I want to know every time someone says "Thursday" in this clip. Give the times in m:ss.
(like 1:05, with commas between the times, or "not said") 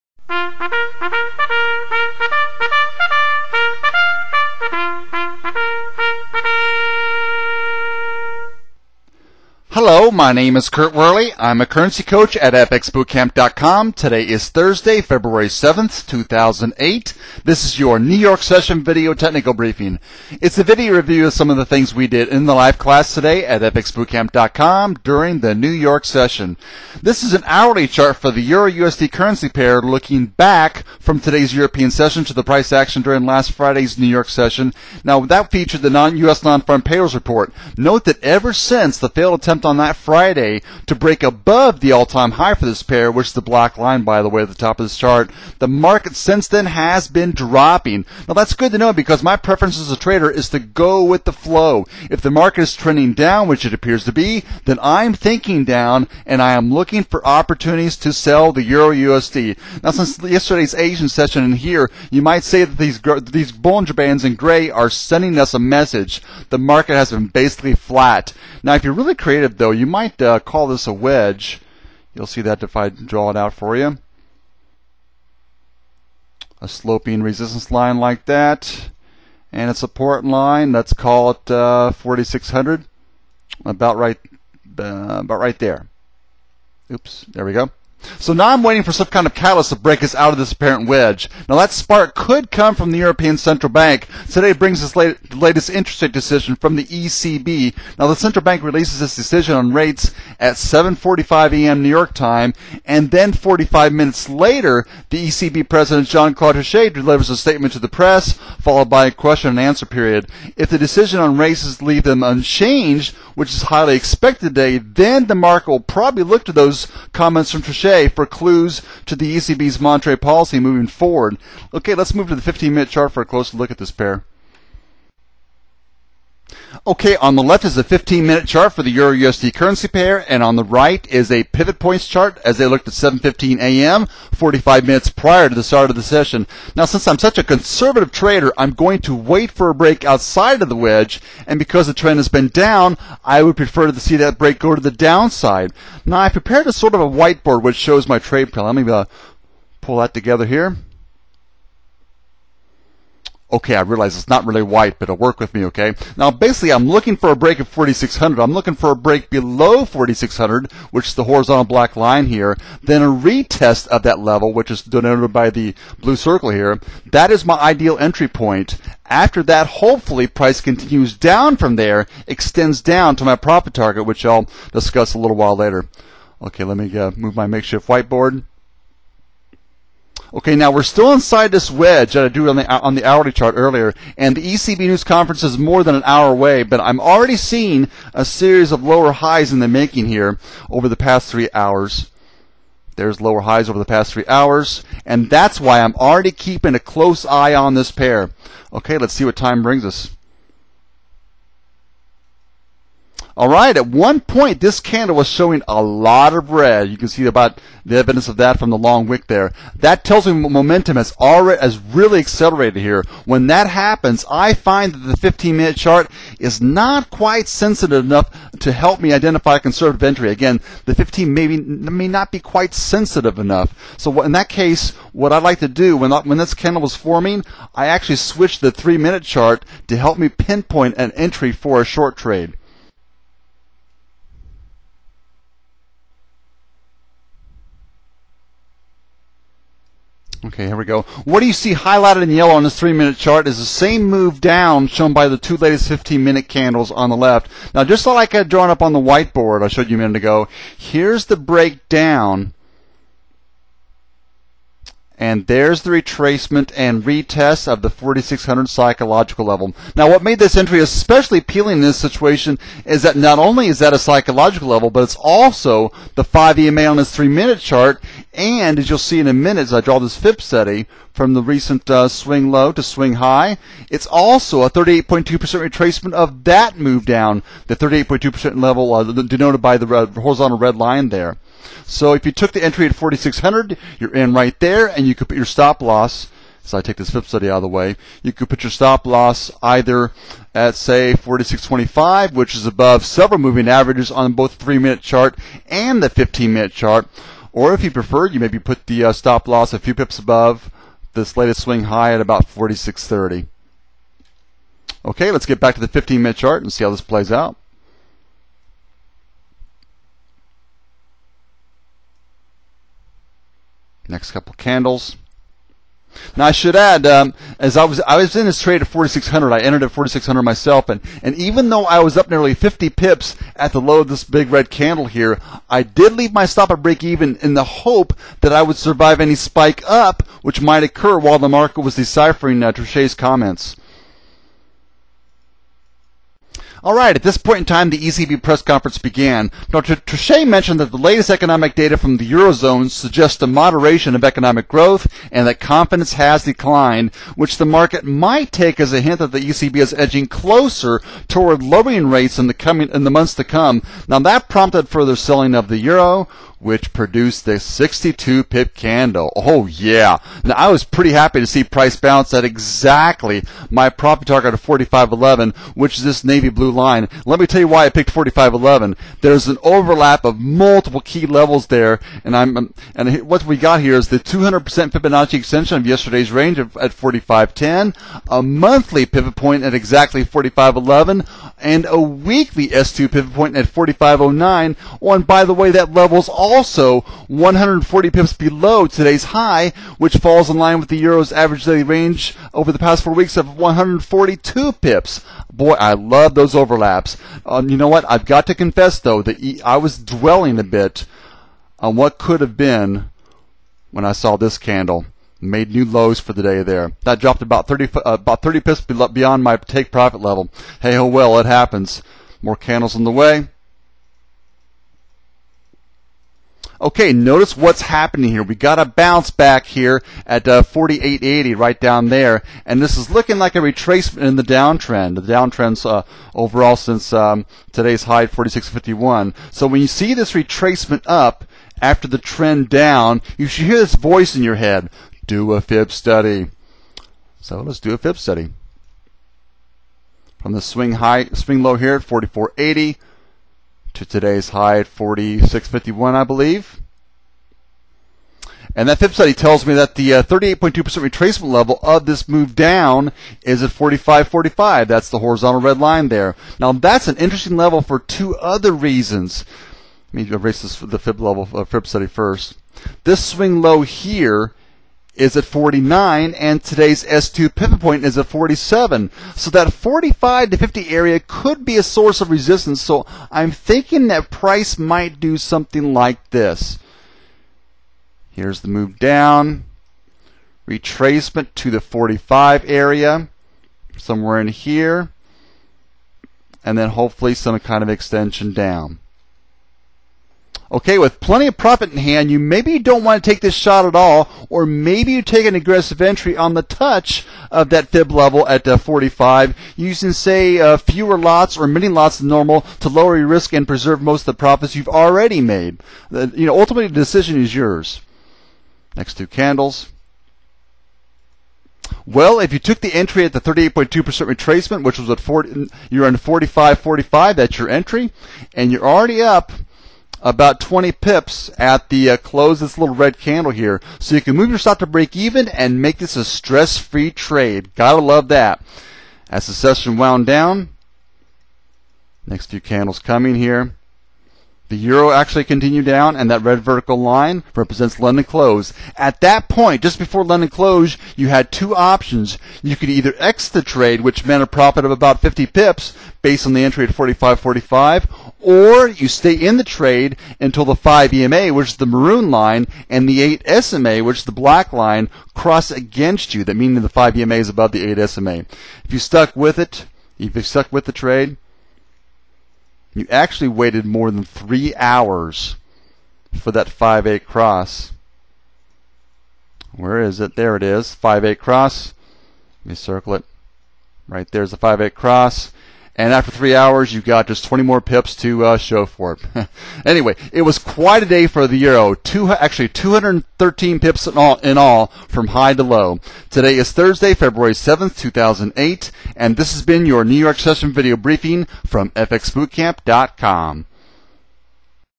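0:14, 9:46.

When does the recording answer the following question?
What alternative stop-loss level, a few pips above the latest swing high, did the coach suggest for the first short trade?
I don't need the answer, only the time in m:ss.
5:02.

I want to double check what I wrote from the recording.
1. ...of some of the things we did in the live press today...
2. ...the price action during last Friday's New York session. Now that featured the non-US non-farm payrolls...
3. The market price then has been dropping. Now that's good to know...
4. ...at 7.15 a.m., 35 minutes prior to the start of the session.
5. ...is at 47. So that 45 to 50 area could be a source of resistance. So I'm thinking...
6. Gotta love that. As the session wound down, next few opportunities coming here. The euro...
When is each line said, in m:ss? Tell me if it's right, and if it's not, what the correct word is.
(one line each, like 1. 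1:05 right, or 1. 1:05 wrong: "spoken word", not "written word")
1. 0:21 wrong: "class", not "press"
2. 0:32 right
3. 0:45 wrong: "since", not "price"
4. 2:12 wrong: "45", not "35"
5. 7:48 right
6. 8:47 wrong: "candles", not "opportunities".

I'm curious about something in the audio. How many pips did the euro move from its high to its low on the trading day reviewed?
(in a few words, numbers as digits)
213 pips.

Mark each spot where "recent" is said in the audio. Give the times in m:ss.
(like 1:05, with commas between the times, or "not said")
4:31.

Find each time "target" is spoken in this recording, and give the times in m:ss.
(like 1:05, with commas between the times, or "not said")
2:53, 6:04.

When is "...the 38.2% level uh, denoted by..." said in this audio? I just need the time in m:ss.
4:37.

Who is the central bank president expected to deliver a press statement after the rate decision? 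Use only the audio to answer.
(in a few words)
Jean-Claude Trichet.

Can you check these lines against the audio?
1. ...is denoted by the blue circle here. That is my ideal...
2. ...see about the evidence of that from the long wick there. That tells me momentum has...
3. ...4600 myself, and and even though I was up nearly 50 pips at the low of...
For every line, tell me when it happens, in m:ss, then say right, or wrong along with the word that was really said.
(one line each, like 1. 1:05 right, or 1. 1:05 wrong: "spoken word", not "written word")
1. 2:44 right
2. 3:27 right
3. 5:19 right.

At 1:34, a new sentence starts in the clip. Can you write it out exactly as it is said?
Today brings us late, the latest interest rate decision from the ECB.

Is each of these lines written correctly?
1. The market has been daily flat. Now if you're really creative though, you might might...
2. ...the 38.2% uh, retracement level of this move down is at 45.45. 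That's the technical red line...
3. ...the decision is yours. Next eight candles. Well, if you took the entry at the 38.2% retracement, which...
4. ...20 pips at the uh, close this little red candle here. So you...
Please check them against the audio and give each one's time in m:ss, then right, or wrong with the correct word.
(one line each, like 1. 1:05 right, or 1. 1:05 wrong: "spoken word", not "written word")
1. 1:06 wrong: "basically", not "daily"
2. 7:29 wrong: "horizontal", not "technical"
3. 8:26 wrong: "two", not "eight"
4. 8:40 right.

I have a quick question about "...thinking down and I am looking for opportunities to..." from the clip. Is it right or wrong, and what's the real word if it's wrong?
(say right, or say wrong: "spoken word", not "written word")
right.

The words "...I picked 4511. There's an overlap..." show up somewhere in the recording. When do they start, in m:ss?
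6:07.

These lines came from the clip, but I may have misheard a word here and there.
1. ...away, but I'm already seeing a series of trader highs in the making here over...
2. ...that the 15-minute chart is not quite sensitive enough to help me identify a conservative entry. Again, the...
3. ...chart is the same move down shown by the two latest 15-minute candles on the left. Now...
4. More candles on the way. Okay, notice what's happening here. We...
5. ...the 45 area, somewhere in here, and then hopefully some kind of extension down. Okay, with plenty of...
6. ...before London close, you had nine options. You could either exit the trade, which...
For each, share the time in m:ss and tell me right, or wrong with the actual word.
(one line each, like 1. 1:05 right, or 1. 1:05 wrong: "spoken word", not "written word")
1. 3:06 wrong: "lower", not "trader"
2. 3:34 right
3. 4:03 right
4. 6:52 right
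5. 8:01 right
6. 8:59 wrong: "two", not "nine".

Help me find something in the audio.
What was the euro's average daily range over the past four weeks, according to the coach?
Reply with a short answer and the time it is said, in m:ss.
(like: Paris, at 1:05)
142 pips, at 6:33.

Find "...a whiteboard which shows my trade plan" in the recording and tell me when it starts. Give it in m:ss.
2:27.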